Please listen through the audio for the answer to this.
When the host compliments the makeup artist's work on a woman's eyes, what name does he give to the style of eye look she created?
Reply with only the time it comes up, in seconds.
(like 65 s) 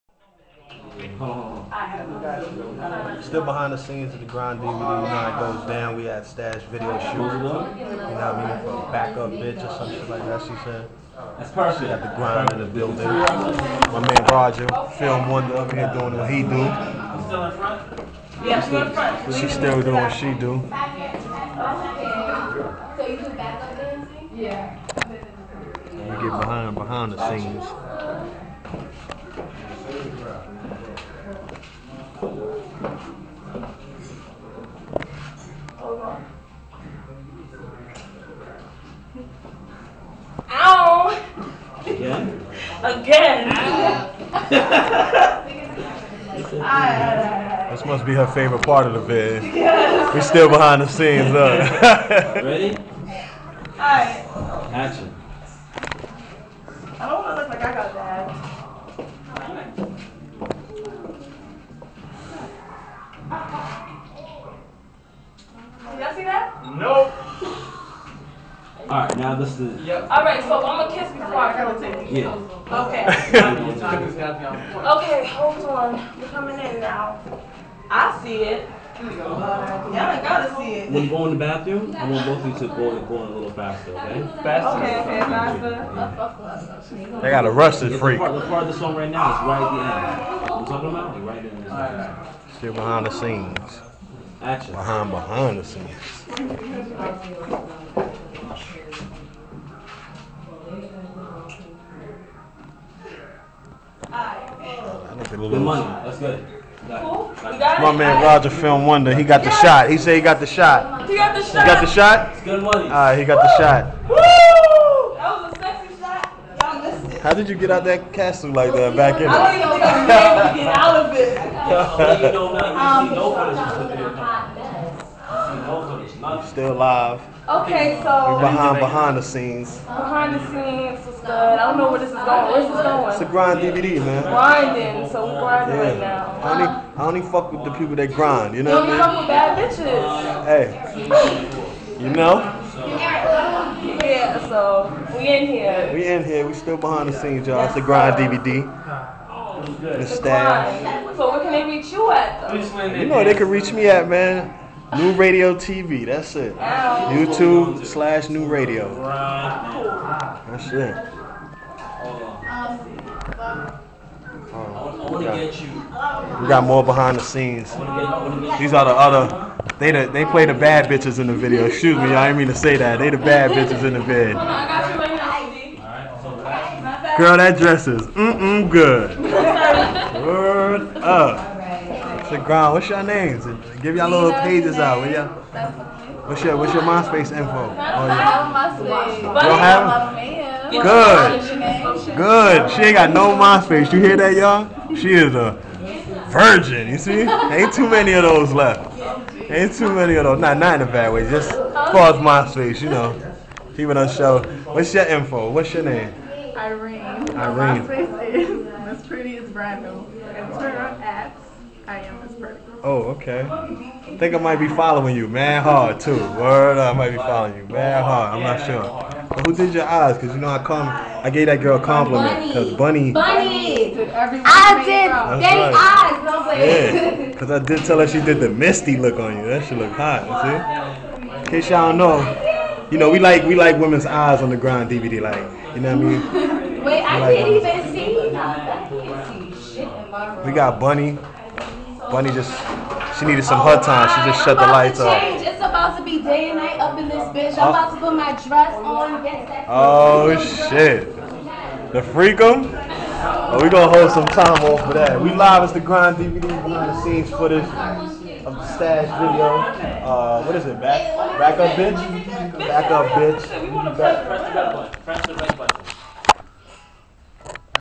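228 s.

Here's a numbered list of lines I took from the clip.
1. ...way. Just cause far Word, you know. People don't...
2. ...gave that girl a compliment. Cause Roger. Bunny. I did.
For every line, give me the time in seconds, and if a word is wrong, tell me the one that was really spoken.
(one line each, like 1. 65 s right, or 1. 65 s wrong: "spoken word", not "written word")
1. 201 s wrong: "MySpace", not "Word"
2. 221 s wrong: "Bunny", not "Roger".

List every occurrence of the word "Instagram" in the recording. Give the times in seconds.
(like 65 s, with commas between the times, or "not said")
210 s.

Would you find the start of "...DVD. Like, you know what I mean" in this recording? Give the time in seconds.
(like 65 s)
234 s.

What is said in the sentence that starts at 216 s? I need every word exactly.
Word, I might be following you, man hard.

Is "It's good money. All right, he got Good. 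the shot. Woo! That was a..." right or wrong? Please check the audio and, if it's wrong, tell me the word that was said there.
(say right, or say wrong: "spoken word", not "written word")
wrong: "Woo", not "Good".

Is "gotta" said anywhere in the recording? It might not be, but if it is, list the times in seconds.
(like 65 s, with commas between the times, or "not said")
80 s, 87 s.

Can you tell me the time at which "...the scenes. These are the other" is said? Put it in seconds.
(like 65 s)
167 s.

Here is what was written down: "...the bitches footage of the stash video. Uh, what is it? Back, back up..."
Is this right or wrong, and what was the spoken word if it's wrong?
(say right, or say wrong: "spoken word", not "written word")
wrong: "scenes", not "bitches".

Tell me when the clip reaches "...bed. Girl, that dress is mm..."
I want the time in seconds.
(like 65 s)
174 s.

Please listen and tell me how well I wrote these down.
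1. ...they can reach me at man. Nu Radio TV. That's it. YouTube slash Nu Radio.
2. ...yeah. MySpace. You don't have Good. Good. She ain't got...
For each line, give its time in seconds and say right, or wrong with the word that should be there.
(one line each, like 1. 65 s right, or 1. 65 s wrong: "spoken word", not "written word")
1. 153 s right
2. 187 s right.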